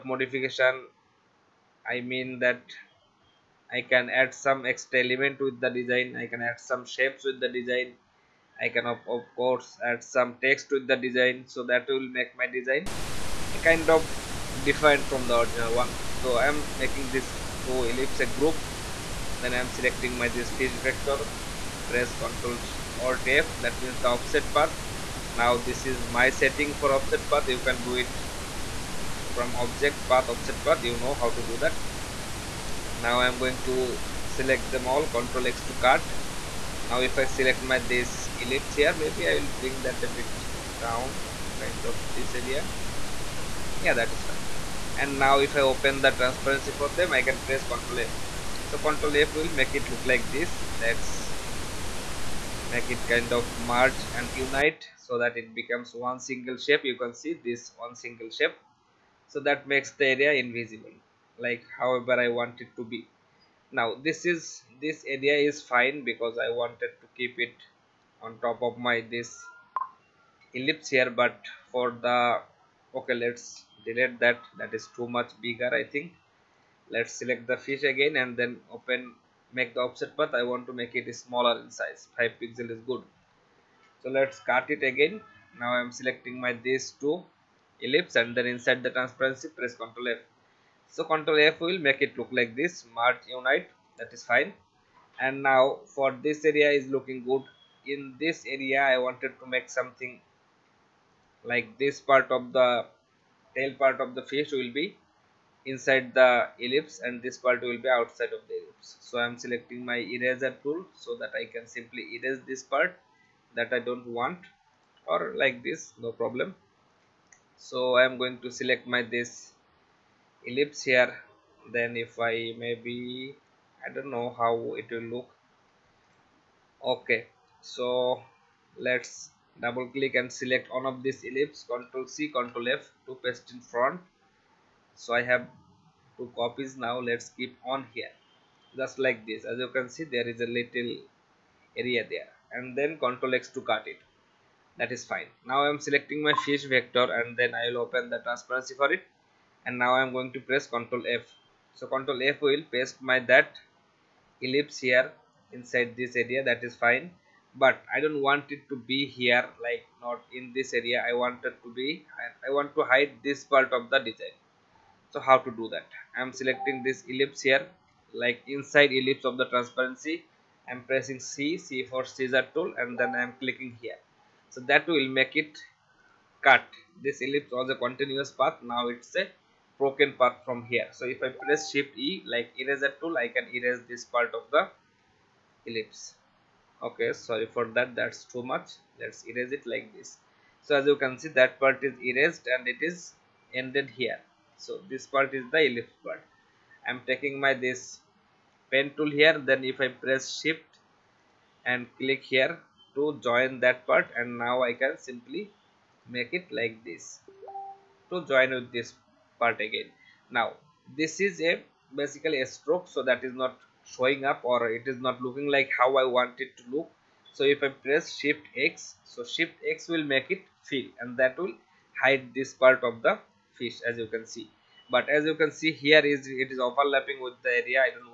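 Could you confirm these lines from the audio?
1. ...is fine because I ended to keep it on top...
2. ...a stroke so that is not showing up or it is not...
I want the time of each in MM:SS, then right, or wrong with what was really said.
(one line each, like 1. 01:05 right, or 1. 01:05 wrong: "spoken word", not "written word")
1. 01:05 wrong: "wanted", not "ended"
2. 03:32 right.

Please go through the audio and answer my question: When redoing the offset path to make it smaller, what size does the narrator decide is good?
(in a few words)
5 pixels.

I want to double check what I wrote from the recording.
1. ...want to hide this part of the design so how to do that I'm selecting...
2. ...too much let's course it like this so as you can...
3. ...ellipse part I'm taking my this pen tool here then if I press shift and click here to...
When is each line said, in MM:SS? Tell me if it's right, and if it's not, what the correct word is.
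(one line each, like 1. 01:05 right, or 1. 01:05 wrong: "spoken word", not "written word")
1. 02:42 right
2. 03:08 wrong: "erase", not "course"
3. 03:15 right.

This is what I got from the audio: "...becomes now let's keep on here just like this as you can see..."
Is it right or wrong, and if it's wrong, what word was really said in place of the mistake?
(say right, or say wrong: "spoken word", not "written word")
wrong: "copies", not "becomes".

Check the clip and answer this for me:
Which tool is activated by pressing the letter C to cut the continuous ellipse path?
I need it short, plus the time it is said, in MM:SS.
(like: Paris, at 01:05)
Scissor tool, at 02:52.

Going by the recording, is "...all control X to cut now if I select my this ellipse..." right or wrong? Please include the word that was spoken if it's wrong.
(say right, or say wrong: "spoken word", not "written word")
right.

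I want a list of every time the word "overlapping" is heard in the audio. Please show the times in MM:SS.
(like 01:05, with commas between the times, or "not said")
03:46.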